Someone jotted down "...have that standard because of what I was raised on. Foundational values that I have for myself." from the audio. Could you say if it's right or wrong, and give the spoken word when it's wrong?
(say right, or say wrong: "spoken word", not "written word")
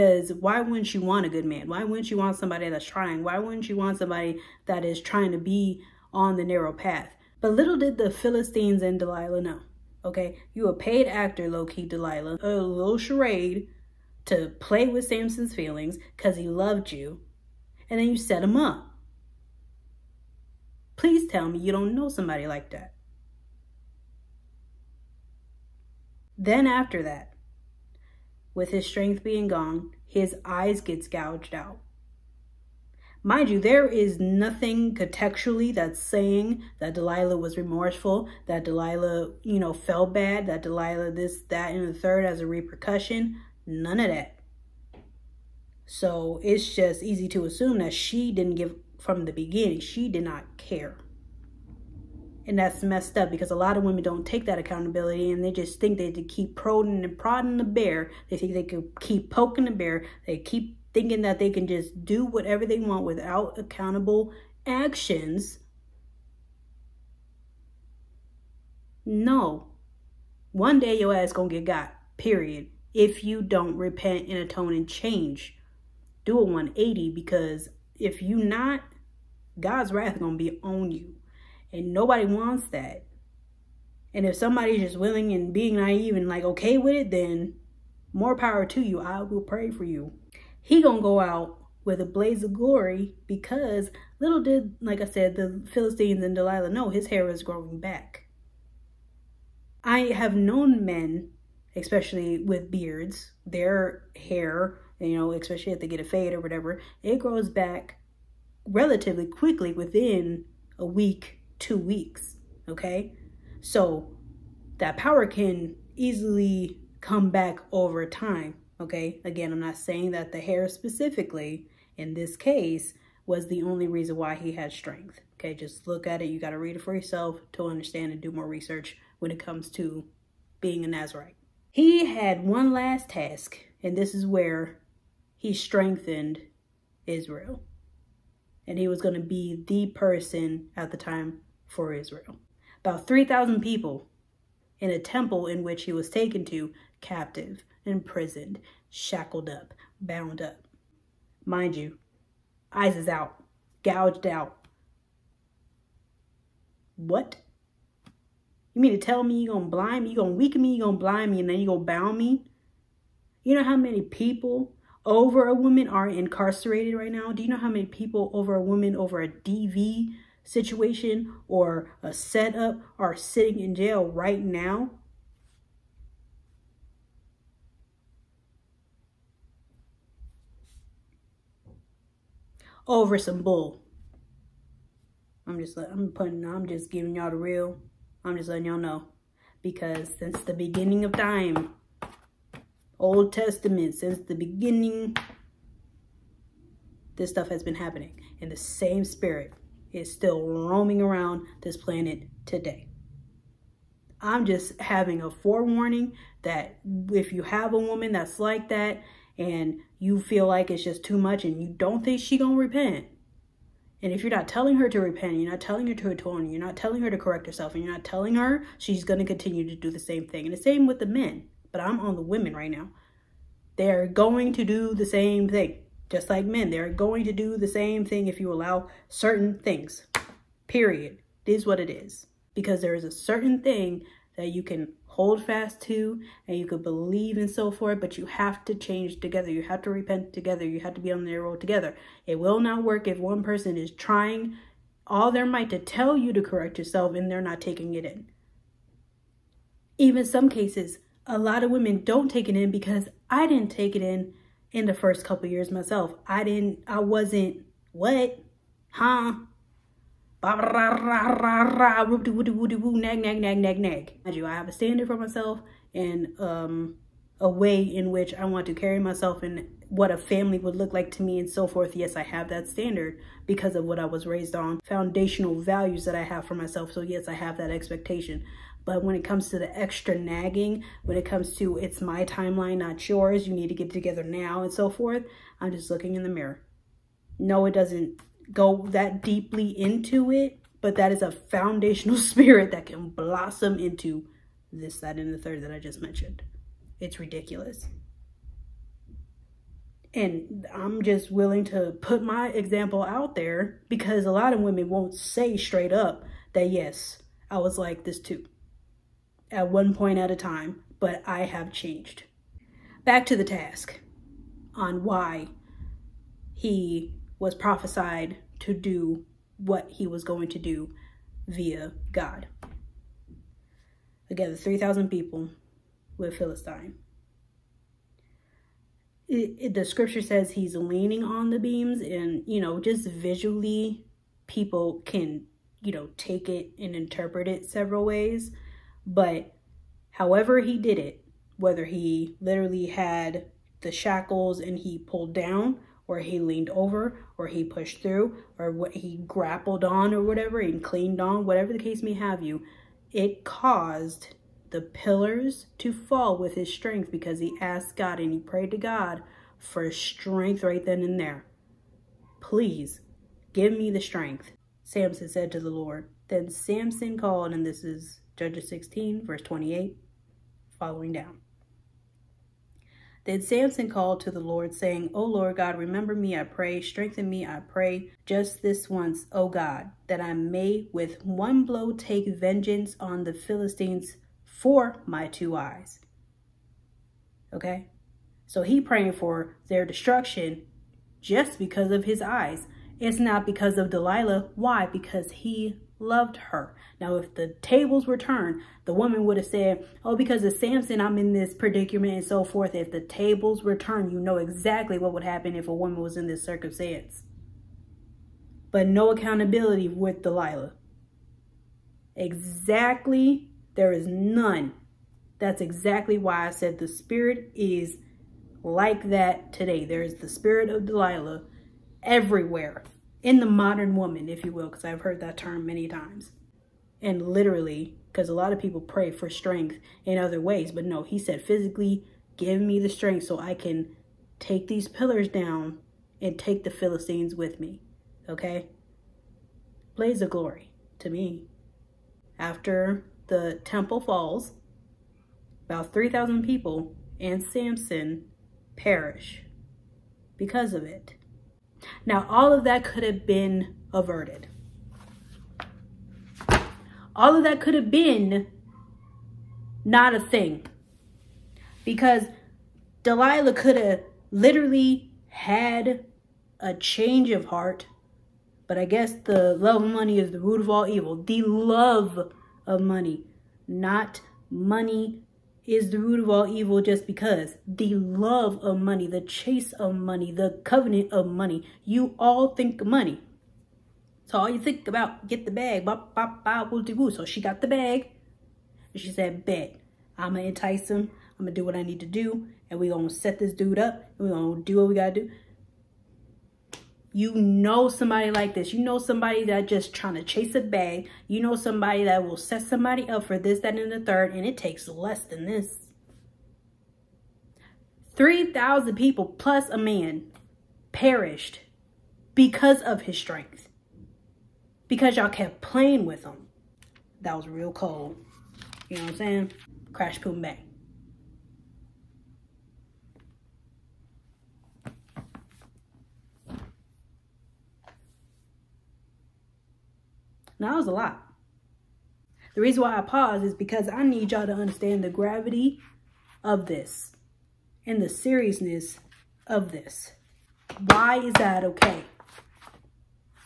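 right.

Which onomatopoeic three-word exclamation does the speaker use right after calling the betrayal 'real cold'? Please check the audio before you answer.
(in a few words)
Crash Boom Bang.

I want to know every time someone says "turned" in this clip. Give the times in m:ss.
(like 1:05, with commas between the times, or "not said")
6:38, 6:43.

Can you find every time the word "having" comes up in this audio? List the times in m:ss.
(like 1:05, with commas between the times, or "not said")
3:24.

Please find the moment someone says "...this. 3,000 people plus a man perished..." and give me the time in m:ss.
8:25.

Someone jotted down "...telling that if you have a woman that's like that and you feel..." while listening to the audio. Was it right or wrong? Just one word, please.
wrong.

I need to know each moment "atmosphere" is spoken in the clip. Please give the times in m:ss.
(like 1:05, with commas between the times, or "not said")
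not said.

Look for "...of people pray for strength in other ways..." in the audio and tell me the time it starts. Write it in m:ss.
7:08.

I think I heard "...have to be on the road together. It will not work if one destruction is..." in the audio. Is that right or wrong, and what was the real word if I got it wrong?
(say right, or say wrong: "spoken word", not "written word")
wrong: "person", not "destruction".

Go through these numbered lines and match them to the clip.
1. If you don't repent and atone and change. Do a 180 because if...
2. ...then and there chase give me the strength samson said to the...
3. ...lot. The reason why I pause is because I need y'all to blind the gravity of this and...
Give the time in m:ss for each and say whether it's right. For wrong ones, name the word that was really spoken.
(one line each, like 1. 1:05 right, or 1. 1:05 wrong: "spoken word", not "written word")
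1. 1:12 right
2. 6:00 wrong: "please", not "chase"
3. 8:50 wrong: "understand", not "blind".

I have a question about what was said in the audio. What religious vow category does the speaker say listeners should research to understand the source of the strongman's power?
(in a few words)
Nazarite.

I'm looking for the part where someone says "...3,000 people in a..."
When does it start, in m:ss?
2:23.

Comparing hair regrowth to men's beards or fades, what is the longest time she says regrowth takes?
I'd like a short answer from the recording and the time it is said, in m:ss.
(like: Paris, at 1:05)
2 weeks, at 1:51.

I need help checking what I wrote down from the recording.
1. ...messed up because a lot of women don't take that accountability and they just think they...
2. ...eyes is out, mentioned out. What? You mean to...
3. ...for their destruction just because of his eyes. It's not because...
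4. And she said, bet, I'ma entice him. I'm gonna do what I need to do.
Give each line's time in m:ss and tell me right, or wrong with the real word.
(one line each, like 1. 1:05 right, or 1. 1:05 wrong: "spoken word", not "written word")
1. 0:52 right
2. 2:32 wrong: "gouged", not "mentioned"
3. 6:29 right
4. 8:08 right.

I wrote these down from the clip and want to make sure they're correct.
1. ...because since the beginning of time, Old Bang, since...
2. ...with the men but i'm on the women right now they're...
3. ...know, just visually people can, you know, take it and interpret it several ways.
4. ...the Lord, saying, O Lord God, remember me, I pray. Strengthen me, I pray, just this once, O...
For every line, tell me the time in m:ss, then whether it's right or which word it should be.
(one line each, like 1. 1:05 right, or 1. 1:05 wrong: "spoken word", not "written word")
1. 3:09 wrong: "Testament", not "Bang"
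2. 3:40 right
3. 5:32 right
4. 6:14 right.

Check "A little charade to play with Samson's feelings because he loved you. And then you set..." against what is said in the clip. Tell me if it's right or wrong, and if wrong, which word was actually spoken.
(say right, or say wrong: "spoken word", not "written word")
right.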